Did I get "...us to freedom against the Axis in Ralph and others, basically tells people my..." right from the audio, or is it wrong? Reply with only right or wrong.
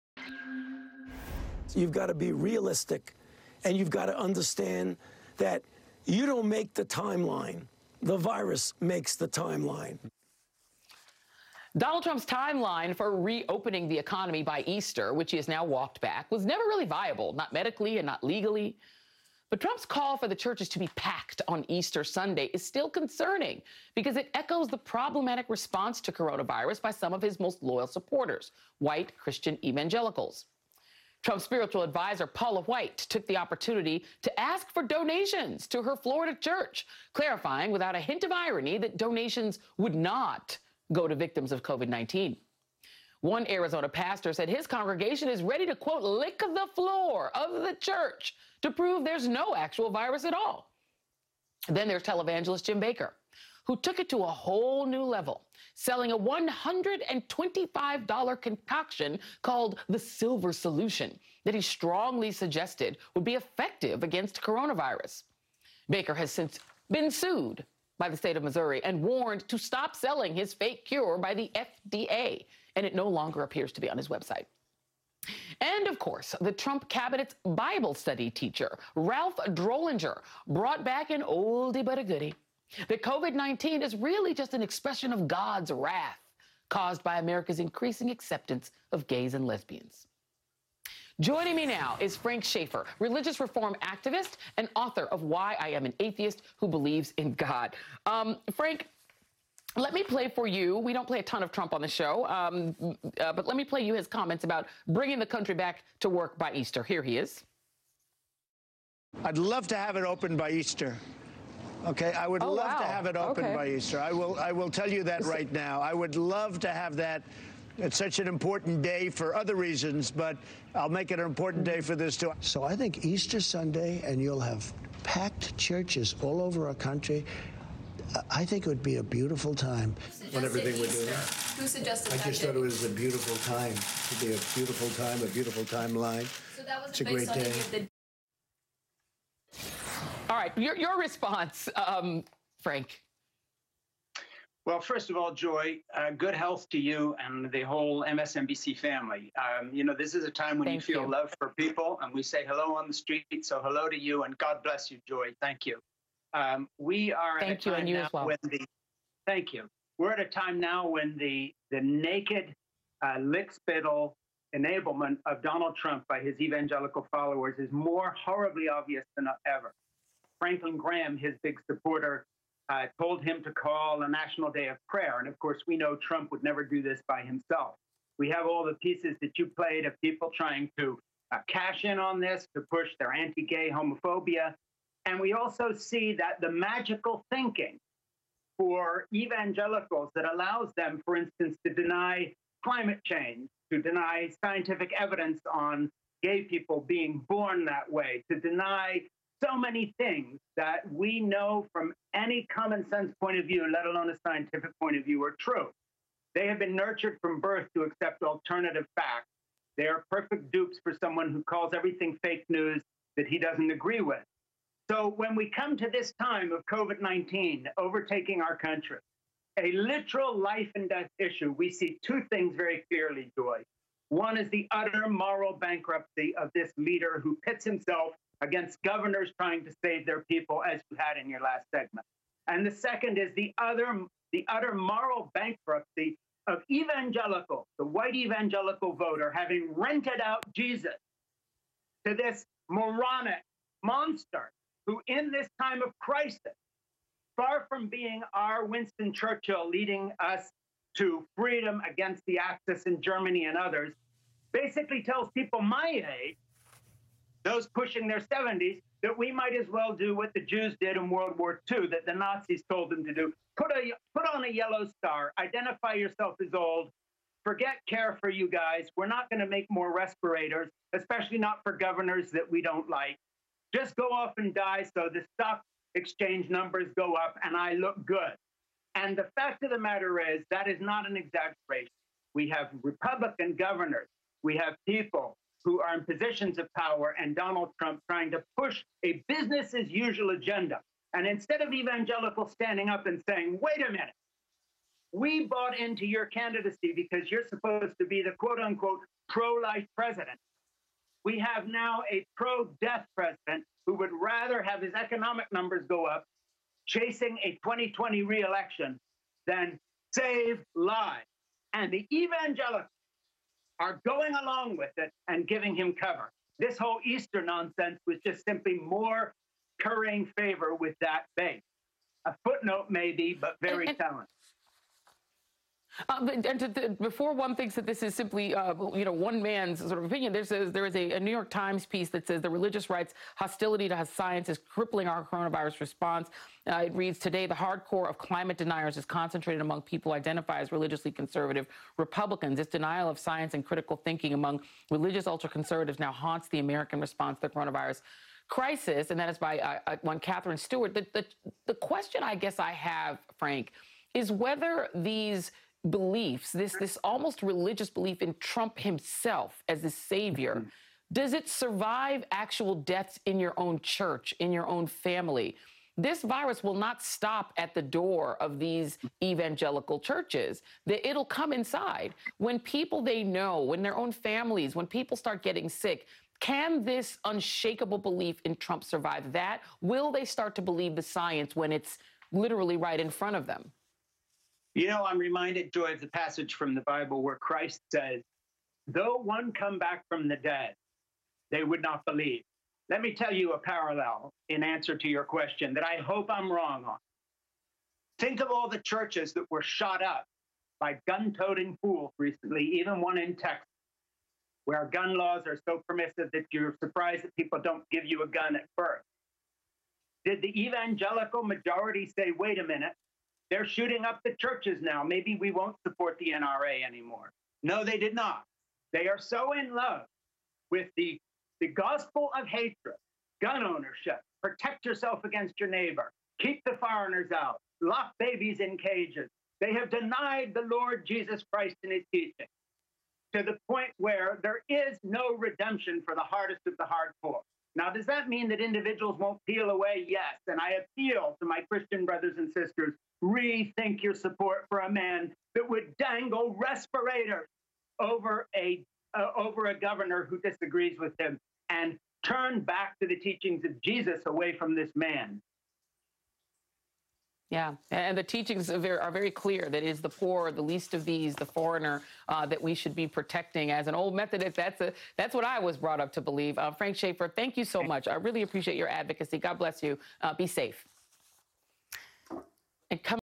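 wrong.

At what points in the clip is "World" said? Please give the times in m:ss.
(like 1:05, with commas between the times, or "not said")
4:21.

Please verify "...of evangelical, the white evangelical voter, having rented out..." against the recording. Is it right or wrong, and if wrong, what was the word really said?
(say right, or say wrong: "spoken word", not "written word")
right.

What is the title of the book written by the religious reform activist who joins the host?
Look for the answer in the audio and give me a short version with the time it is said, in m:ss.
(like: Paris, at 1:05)
Why I Am an Atheist Who Believes in God, at 1:35.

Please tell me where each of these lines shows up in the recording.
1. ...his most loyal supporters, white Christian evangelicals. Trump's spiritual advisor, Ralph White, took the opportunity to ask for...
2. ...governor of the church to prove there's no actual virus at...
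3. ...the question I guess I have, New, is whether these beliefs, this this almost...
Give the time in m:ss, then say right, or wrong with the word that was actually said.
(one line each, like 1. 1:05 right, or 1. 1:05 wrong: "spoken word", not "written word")
1. 0:27 wrong: "Paula", not "Ralph"
2. 0:46 wrong: "floor", not "governor"
3. 5:51 wrong: "Frank", not "New".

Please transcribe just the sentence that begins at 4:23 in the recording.
Put, a, put on a yellow star, identify yourself as old, forget care for you guys.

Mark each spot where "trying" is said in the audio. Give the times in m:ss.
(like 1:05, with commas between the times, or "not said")
3:00, 3:49, 4:48.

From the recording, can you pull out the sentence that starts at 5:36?
Uh, it reads today the hardcore of climate deniers is concentrated among people identified as religiously conservative Republicans.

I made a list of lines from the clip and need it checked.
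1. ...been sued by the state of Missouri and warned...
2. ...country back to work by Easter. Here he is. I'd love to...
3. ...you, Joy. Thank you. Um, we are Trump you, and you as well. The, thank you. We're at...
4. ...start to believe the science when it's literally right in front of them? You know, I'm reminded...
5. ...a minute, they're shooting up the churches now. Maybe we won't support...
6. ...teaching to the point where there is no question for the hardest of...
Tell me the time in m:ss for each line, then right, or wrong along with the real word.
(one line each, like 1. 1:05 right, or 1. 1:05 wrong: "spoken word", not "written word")
1. 1:06 right
2. 1:45 right
3. 2:34 wrong: "Thank", not "Trump"
4. 6:20 right
5. 6:52 right
6. 7:12 wrong: "redemption", not "question".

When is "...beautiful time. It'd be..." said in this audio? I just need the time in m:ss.
2:12.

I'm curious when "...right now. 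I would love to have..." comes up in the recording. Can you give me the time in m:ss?
1:55.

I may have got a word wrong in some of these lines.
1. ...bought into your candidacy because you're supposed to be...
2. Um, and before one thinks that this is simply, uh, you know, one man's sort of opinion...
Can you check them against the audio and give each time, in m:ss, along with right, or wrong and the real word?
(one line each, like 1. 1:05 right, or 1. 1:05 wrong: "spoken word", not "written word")
1. 4:55 right
2. 5:26 right.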